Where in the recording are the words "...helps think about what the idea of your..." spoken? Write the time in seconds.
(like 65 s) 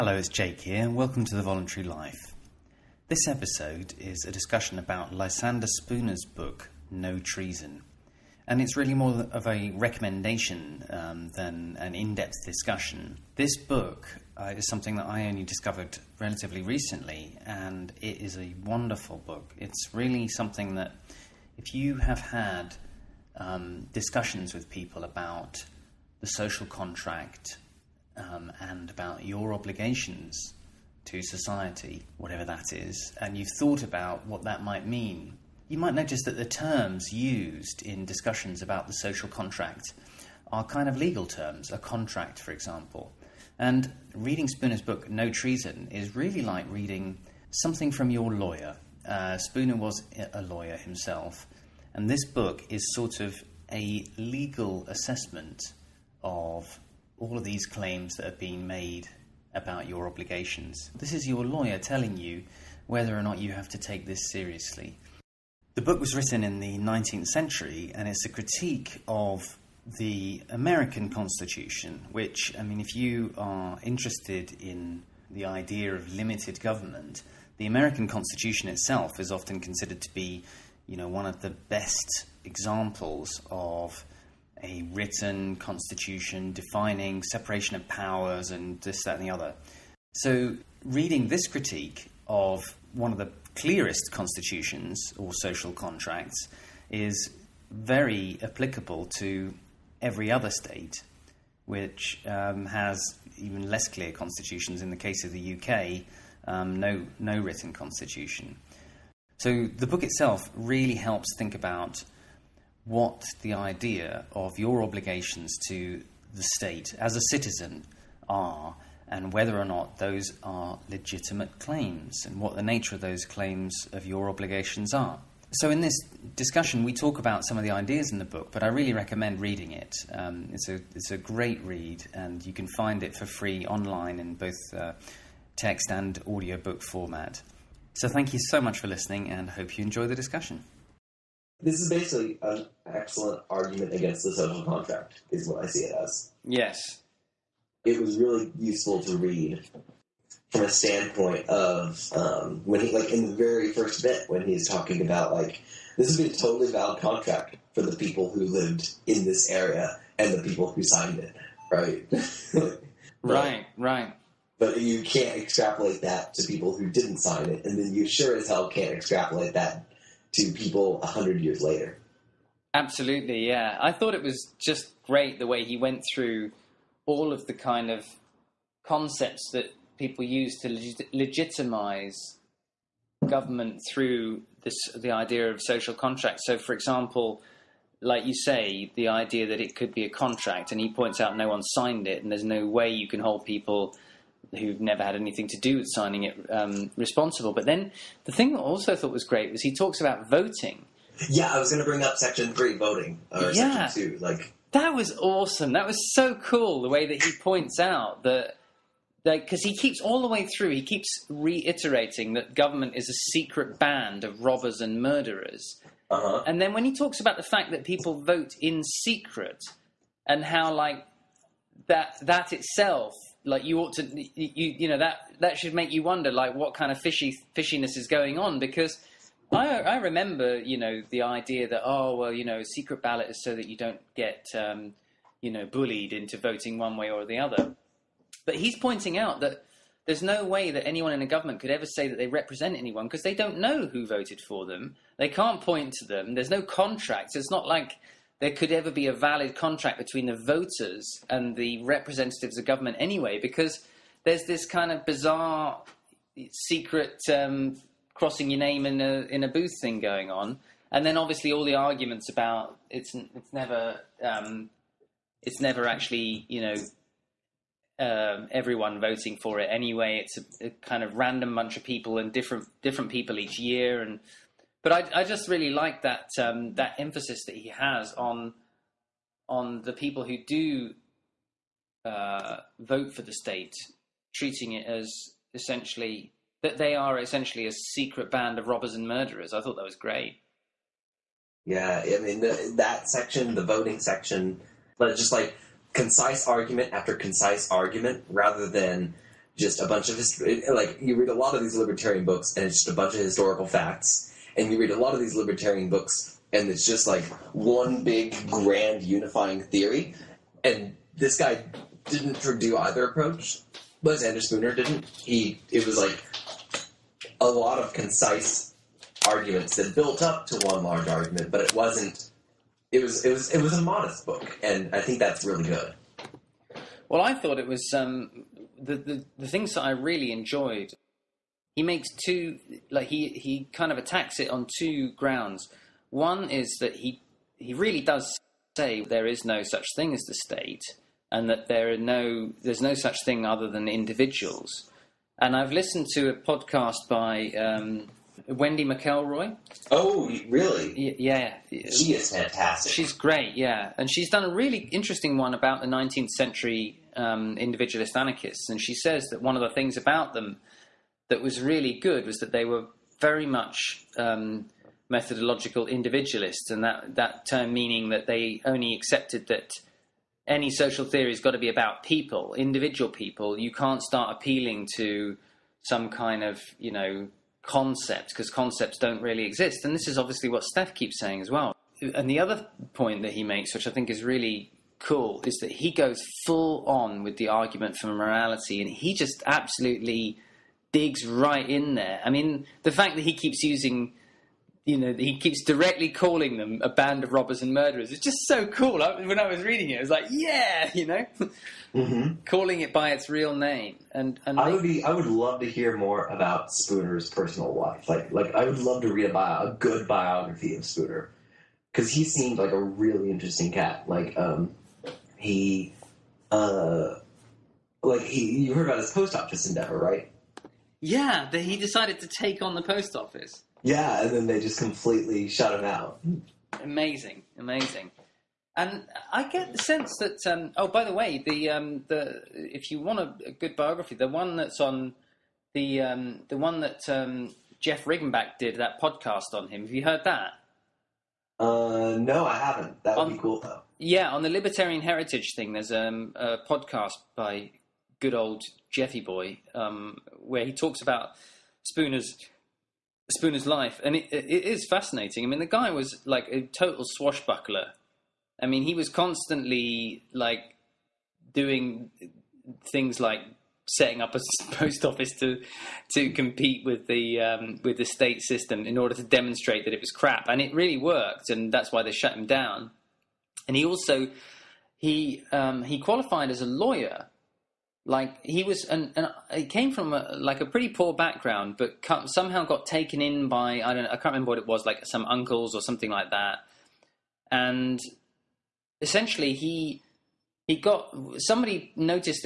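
110 s.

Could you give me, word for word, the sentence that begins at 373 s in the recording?
You can't start appealing to some kind of, you know, concept because concepts don't really exist.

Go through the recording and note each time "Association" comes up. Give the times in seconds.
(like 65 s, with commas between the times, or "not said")
not said.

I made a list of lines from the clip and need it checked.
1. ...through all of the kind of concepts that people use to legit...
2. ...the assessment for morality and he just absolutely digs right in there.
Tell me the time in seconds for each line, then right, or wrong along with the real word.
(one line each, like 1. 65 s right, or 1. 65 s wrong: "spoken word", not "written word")
1. 176 s right
2. 387 s wrong: "argument", not "assessment".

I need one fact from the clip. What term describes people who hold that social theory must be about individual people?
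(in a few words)
Methodological individualists.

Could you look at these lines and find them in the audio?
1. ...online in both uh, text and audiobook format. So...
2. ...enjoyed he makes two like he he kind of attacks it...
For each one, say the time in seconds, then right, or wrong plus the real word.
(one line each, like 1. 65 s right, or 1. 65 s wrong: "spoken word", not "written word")
1. 133 s right
2. 330 s right.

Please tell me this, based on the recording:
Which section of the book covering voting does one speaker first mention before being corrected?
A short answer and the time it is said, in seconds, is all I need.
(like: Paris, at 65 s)
Section three, at 202 s.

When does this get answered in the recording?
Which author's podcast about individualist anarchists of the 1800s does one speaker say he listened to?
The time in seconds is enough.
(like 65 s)
348 s.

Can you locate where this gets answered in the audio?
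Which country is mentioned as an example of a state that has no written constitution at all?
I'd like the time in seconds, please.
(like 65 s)
105 s.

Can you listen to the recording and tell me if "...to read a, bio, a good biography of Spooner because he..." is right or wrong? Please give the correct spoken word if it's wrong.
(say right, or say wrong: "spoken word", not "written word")
right.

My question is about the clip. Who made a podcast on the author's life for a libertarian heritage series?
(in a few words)
Jeff Riggenbach.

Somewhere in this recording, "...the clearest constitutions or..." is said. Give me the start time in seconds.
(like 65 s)
93 s.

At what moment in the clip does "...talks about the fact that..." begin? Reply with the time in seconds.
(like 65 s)
216 s.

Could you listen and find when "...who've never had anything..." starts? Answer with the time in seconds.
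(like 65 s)
194 s.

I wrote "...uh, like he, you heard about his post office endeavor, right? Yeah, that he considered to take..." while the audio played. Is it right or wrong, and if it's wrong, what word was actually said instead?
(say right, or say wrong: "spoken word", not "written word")
wrong: "decided", not "considered".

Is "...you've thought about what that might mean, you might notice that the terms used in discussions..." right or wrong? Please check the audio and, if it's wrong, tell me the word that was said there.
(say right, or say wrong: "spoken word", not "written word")
right.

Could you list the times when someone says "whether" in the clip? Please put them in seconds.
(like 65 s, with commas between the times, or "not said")
62 s, 119 s.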